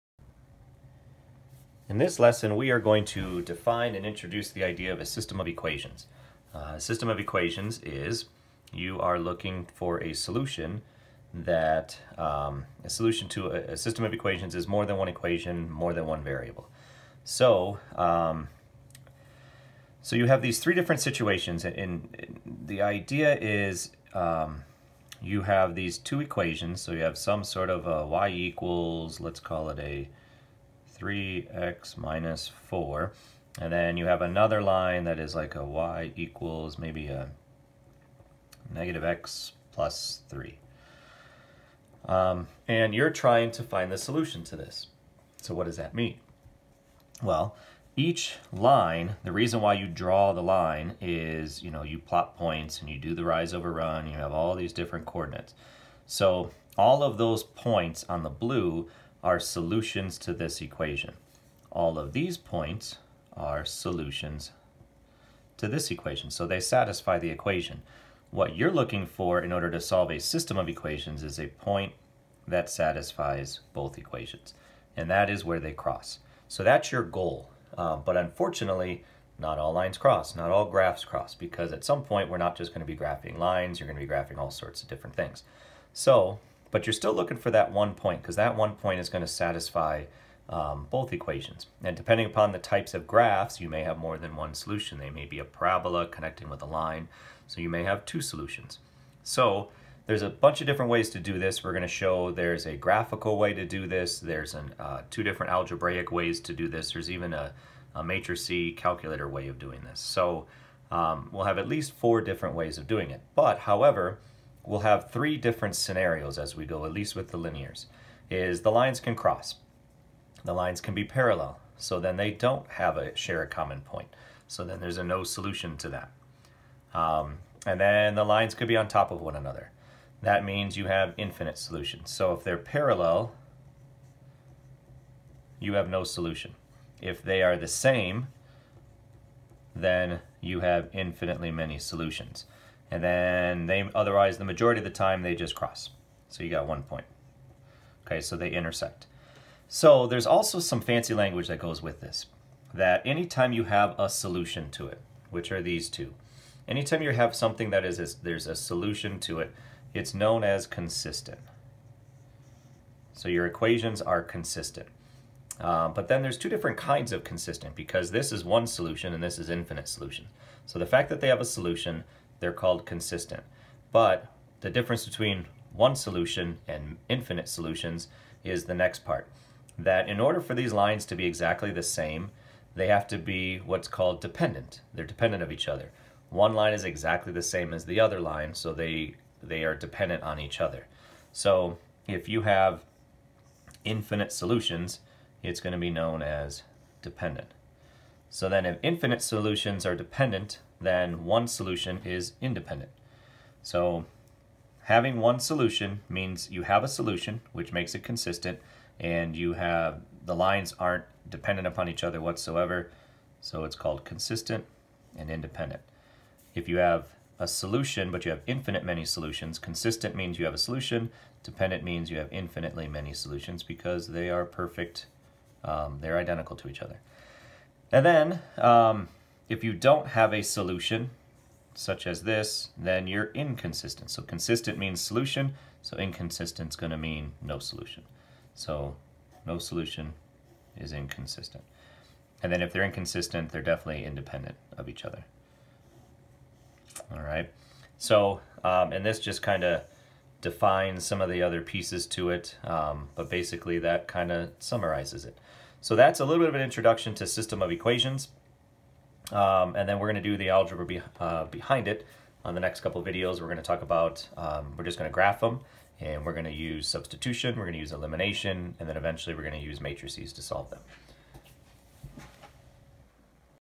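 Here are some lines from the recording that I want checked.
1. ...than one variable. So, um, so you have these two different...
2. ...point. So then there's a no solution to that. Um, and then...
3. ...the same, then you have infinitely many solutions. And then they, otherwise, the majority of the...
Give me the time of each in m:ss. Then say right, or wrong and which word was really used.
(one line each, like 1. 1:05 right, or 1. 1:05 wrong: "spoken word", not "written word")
1. 0:15 wrong: "three", not "two"
2. 2:03 right
3. 2:17 right.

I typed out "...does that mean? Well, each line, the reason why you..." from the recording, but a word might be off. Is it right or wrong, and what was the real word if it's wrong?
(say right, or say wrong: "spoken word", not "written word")
right.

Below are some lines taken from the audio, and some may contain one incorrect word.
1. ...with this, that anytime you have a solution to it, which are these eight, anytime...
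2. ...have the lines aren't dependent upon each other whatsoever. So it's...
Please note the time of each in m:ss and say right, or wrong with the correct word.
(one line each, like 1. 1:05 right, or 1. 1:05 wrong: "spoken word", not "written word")
1. 2:31 wrong: "two", not "eight"
2. 3:29 right.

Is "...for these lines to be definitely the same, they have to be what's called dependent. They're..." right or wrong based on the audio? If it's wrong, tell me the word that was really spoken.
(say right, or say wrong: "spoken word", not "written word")
wrong: "exactly", not "definitely".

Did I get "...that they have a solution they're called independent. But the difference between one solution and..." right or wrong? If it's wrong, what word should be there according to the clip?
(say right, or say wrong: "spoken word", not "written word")
wrong: "consistent", not "independent".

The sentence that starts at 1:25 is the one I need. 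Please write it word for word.
So but you're still looking for that one point because that one point is going to satisfy um, both equations.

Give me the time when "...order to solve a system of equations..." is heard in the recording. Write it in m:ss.
1:09.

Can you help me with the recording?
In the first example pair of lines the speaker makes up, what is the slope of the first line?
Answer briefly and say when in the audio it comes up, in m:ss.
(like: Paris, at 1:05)
3, at 0:31.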